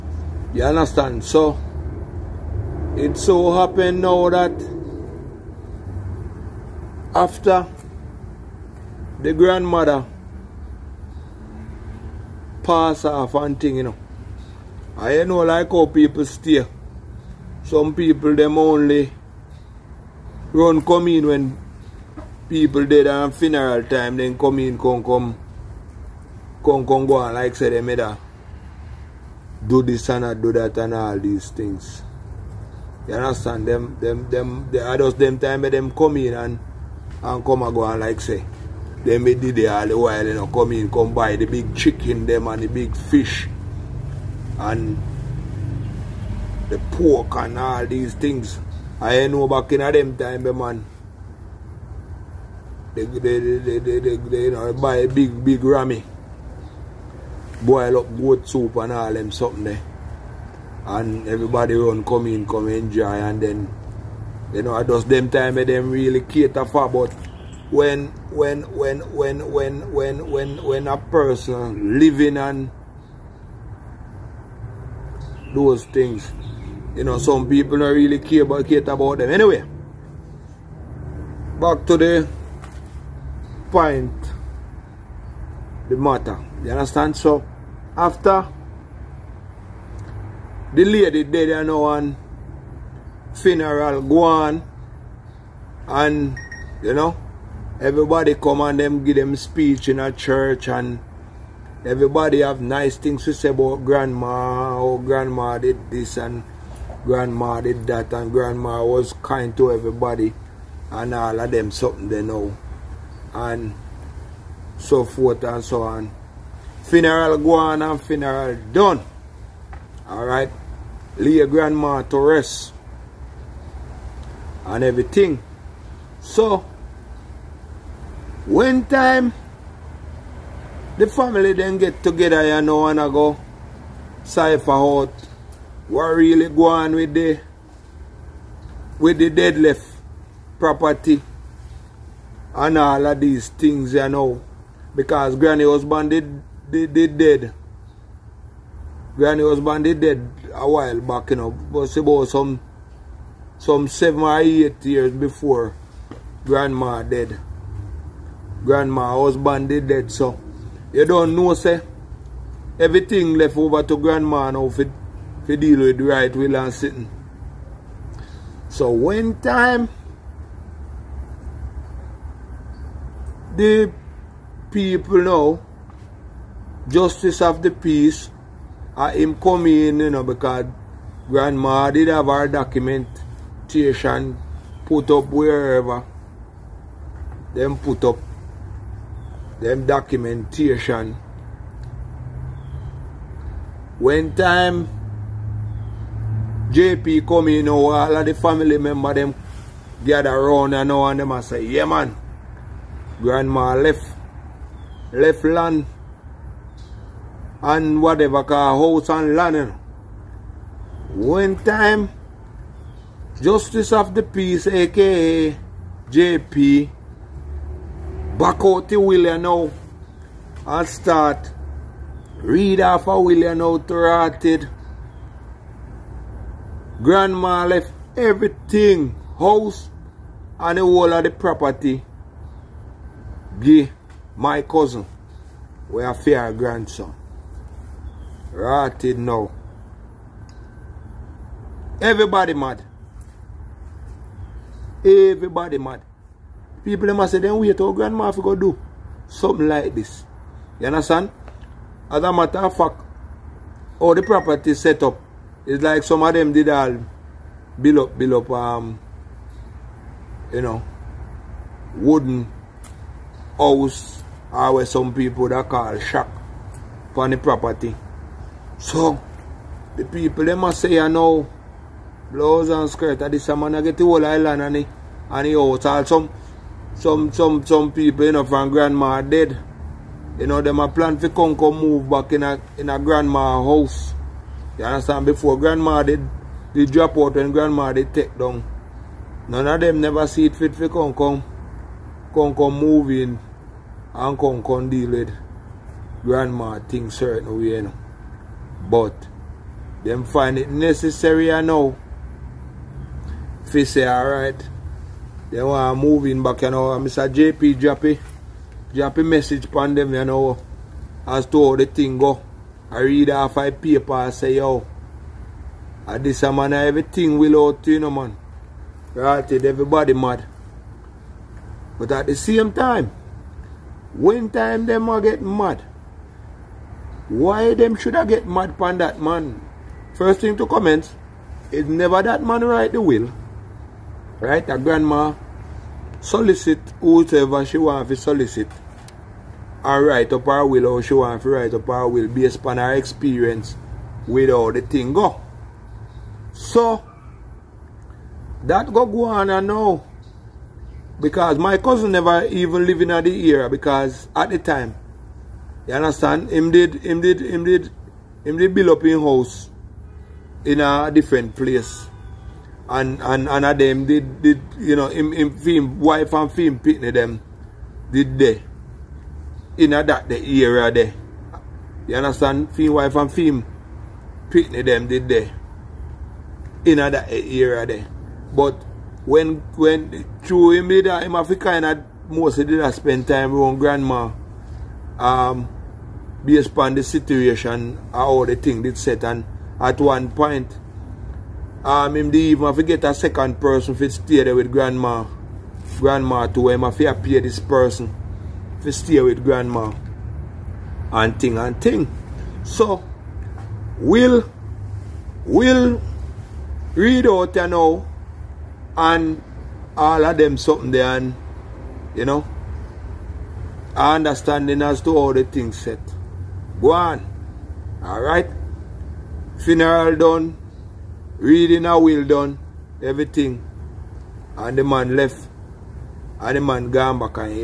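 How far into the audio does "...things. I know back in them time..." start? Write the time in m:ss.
0:48.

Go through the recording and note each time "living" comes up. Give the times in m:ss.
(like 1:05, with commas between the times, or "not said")
1:11.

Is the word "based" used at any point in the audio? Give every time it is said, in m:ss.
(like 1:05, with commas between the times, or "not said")
5:42, 6:26.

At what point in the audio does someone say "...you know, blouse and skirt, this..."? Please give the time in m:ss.
4:30.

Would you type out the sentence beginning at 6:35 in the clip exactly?
Grandma to him if he appear this person.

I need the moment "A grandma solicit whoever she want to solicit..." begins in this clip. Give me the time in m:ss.
5:34.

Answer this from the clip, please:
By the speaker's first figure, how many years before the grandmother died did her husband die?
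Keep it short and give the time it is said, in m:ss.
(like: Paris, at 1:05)
7, at 2:33.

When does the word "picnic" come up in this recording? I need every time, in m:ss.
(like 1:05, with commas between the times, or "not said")
6:06, 6:14.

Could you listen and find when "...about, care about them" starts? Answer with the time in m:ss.
1:18.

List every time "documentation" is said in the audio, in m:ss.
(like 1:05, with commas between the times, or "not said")
3:02, 3:09.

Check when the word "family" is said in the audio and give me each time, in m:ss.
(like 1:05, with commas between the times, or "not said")
2:11, 3:18.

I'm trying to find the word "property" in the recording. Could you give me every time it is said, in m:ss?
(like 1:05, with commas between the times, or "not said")
2:20, 3:51, 4:14, 4:27.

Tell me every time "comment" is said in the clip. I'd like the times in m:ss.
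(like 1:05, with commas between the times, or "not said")
5:30.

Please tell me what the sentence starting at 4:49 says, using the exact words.
None of them never see it fit for come come move in and come deal with grandma thing certain way, you know.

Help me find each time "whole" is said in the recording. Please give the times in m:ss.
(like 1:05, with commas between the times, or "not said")
3:50, 4:34.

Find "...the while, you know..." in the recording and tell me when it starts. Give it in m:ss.
0:39.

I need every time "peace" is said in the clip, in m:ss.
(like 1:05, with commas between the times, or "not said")
2:57, 3:34.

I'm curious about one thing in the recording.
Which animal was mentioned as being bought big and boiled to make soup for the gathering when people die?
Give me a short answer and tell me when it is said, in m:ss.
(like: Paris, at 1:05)
goat, at 0:58.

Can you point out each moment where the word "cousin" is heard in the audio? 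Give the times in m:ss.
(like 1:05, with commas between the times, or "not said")
3:54, 5:51.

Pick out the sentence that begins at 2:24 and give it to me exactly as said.
Because granny husband did did, did dead.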